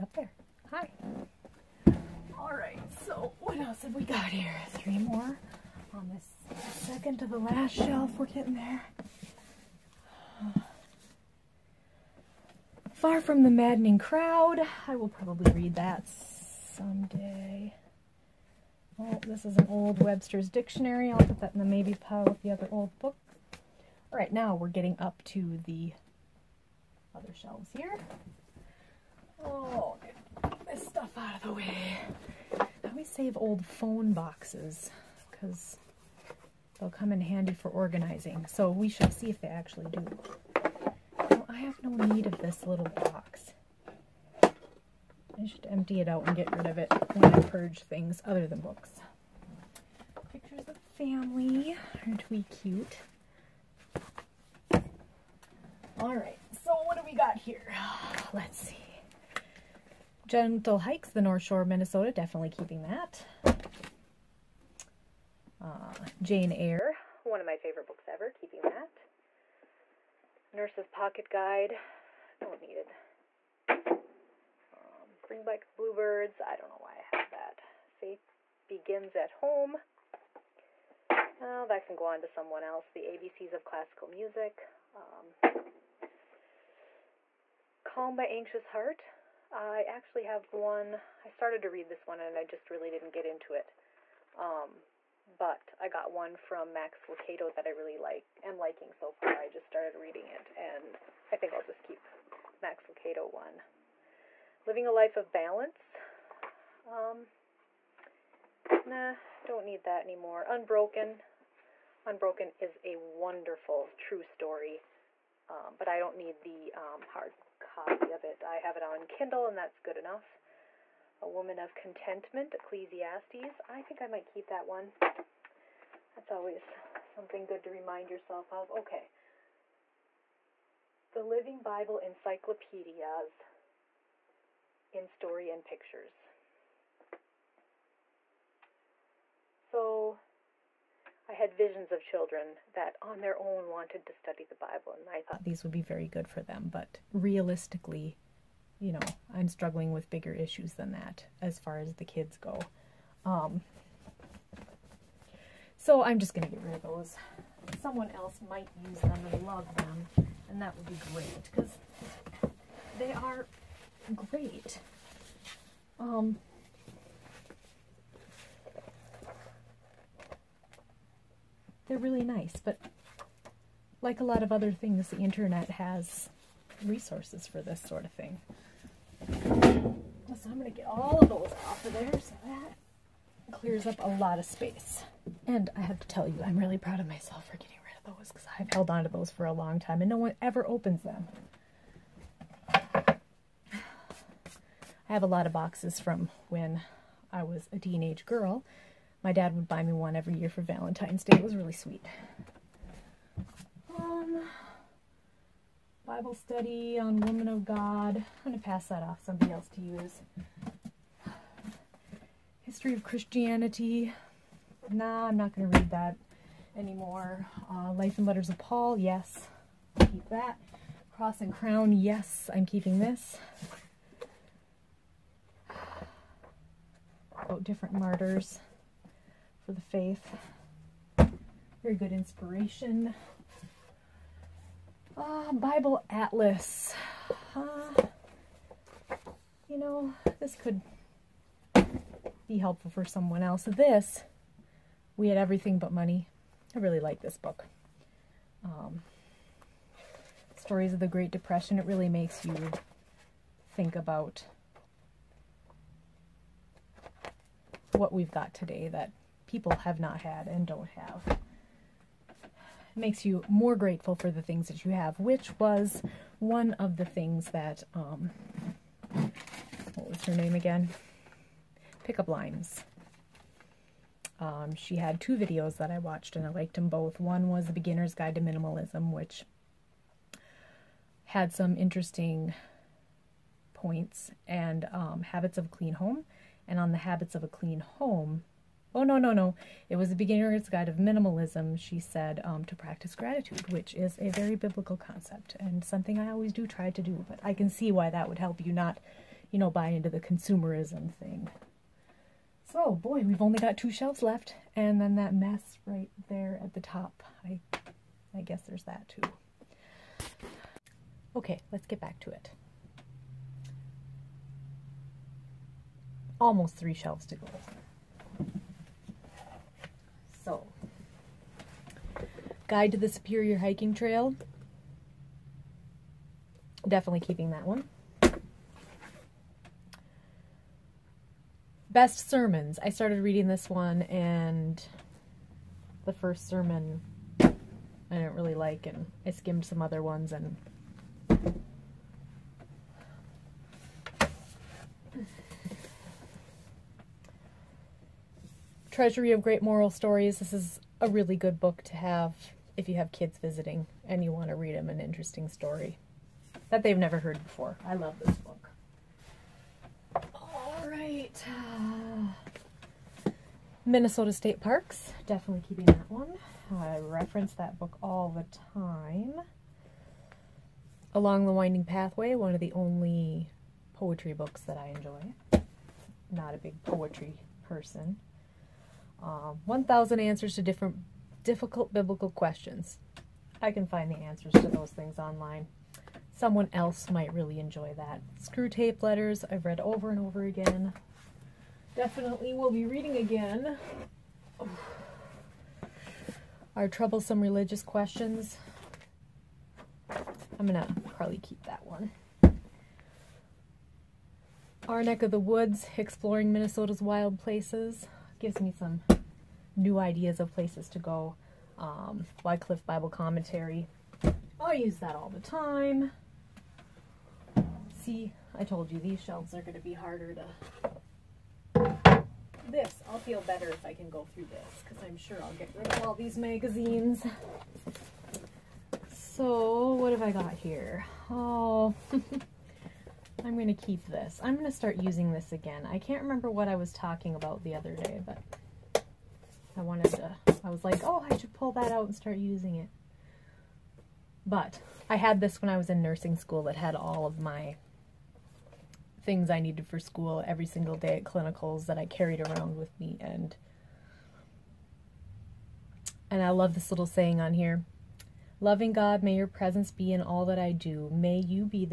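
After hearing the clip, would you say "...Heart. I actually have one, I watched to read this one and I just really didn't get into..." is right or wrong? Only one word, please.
wrong.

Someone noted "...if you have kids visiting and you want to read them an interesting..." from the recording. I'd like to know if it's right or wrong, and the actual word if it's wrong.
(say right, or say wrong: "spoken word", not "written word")
right.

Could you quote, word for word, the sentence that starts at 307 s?
I, I guess there's that too.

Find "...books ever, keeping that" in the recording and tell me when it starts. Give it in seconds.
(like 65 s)
67 s.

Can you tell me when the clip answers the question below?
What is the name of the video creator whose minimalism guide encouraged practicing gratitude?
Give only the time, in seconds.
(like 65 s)
272 s.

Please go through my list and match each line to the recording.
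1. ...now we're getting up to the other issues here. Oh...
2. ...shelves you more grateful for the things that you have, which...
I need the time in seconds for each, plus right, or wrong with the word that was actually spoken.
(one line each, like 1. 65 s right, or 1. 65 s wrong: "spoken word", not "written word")
1. 24 s wrong: "shelves", not "issues"
2. 262 s wrong: "makes", not "shelves".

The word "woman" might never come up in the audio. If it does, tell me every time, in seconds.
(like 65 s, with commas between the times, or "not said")
121 s, 207 s.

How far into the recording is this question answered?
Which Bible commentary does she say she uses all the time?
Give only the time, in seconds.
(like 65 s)
412 s.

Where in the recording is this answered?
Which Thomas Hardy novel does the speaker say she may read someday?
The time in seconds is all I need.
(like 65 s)
12 s.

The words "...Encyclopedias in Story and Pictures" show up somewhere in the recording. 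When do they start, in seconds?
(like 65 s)
131 s.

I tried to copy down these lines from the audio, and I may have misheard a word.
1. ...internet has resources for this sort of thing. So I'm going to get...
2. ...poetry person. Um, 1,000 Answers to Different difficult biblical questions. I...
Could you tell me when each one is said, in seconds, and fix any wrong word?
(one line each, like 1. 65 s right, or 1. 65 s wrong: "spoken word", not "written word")
1. 175 s right
2. 376 s right.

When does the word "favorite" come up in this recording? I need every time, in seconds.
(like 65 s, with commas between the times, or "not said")
67 s.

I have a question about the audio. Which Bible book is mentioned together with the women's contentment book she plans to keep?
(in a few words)
Ecclesiastes.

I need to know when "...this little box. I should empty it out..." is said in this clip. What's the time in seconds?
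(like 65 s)
42 s.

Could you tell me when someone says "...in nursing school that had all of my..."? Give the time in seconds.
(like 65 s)
445 s.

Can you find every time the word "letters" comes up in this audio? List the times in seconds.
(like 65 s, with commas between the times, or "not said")
218 s, 389 s.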